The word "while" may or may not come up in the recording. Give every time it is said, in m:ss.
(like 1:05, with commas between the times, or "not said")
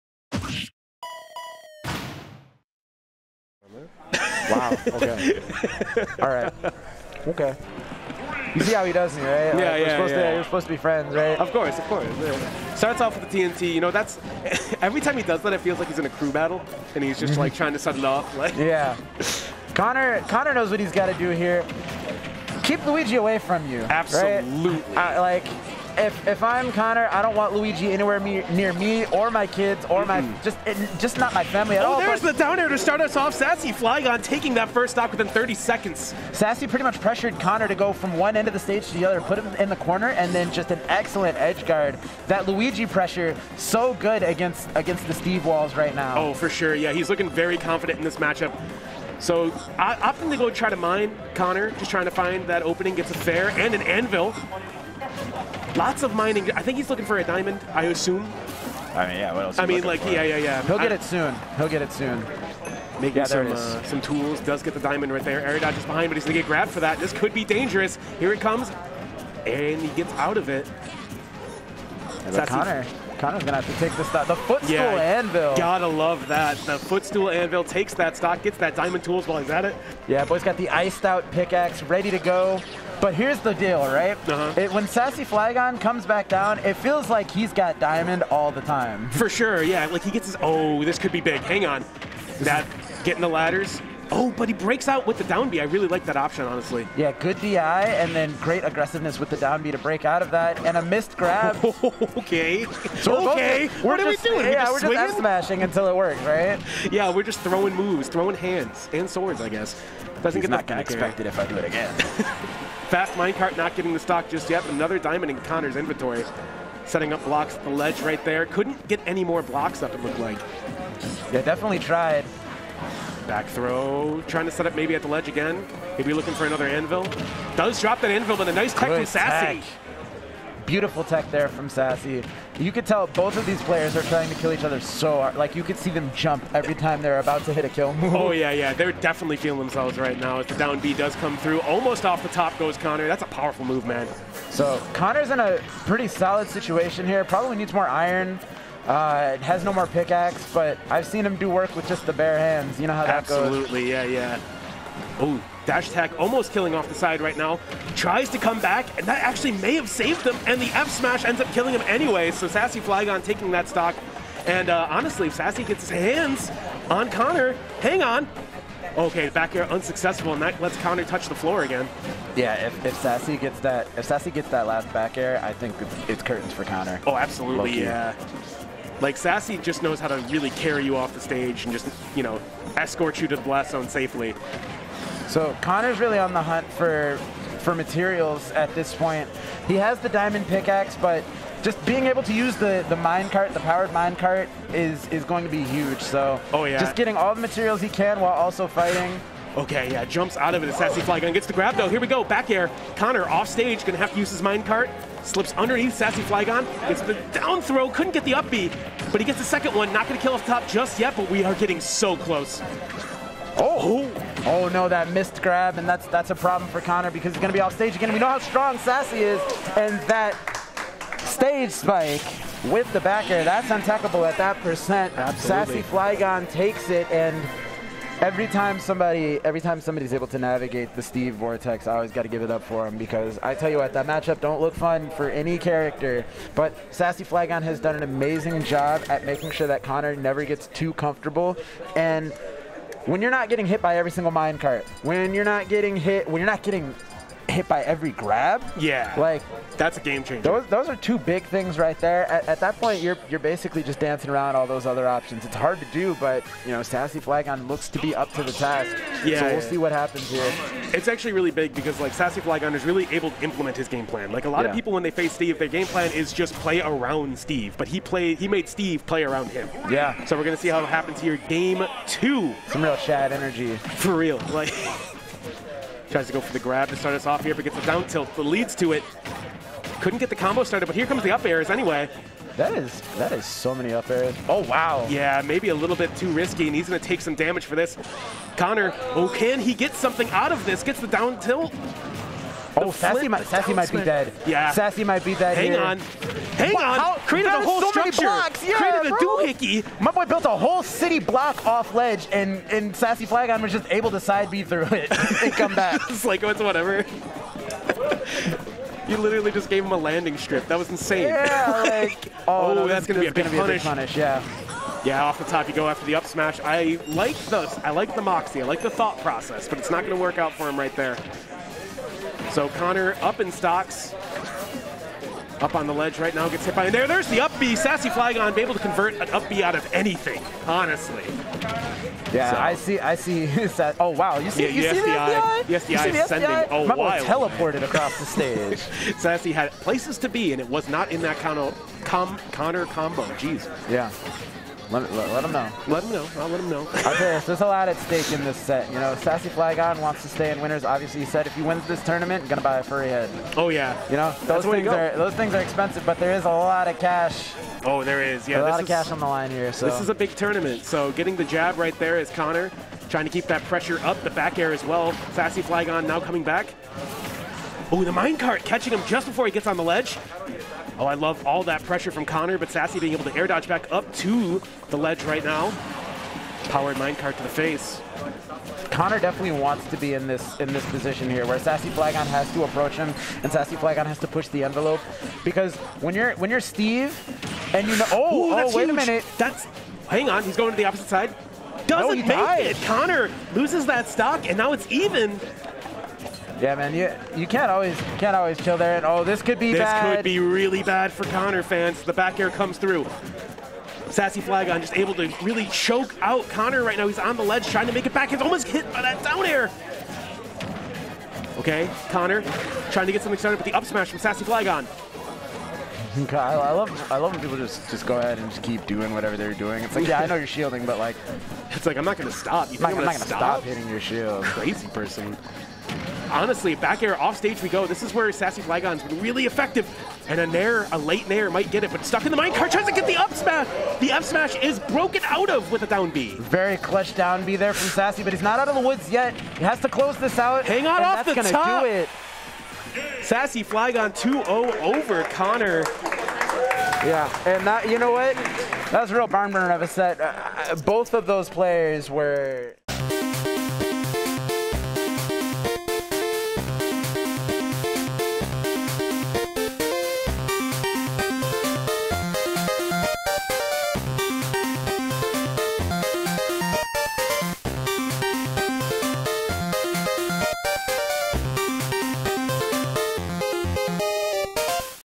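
1:19, 3:18.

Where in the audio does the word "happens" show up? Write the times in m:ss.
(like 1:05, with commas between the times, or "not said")
4:19, 4:30.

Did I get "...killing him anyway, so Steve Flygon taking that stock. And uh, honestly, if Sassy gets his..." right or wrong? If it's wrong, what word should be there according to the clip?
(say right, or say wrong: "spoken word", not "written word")
wrong: "Sassy", not "Steve".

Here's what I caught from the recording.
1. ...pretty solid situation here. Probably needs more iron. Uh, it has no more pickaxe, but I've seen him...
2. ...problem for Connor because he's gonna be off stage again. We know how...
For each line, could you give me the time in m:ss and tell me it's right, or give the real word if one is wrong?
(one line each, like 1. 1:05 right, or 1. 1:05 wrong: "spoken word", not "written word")
1. 2:25 right
2. 3:36 right.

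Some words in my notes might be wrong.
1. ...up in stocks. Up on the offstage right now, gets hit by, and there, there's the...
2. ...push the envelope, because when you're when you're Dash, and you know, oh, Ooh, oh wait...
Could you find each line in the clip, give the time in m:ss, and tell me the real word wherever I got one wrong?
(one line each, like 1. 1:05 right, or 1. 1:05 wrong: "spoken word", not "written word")
1. 5:23 wrong: "ledge", not "offstage"
2. 6:24 wrong: "Steve", not "Dash".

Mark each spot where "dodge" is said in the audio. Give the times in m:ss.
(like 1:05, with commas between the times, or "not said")
1:05, 6:13.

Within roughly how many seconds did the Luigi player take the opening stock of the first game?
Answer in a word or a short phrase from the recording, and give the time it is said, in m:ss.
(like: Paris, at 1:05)
30, at 0:35.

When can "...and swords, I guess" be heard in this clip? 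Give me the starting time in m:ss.
1:48.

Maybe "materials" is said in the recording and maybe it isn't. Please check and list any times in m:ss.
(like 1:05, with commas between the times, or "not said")
3:07, 3:17.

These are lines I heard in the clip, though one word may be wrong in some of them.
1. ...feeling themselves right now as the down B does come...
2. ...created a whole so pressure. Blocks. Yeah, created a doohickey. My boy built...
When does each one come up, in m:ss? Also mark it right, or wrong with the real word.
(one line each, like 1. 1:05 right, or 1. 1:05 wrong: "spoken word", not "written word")
1. 2:19 right
2. 4:57 wrong: "structure", not "pressure".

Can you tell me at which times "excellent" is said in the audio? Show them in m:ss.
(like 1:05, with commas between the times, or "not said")
0:40.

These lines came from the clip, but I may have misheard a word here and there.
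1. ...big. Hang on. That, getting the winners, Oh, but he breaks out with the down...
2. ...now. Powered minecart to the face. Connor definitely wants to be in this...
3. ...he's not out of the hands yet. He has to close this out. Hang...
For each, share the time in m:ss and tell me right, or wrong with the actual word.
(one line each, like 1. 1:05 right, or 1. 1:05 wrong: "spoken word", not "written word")
1. 1:31 wrong: "ladders", not "winners"
2. 6:15 right
3. 7:18 wrong: "woods", not "hands".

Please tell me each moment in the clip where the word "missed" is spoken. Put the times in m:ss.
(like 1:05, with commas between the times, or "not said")
1:40, 3:35.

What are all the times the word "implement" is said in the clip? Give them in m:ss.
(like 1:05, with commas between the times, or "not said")
4:23.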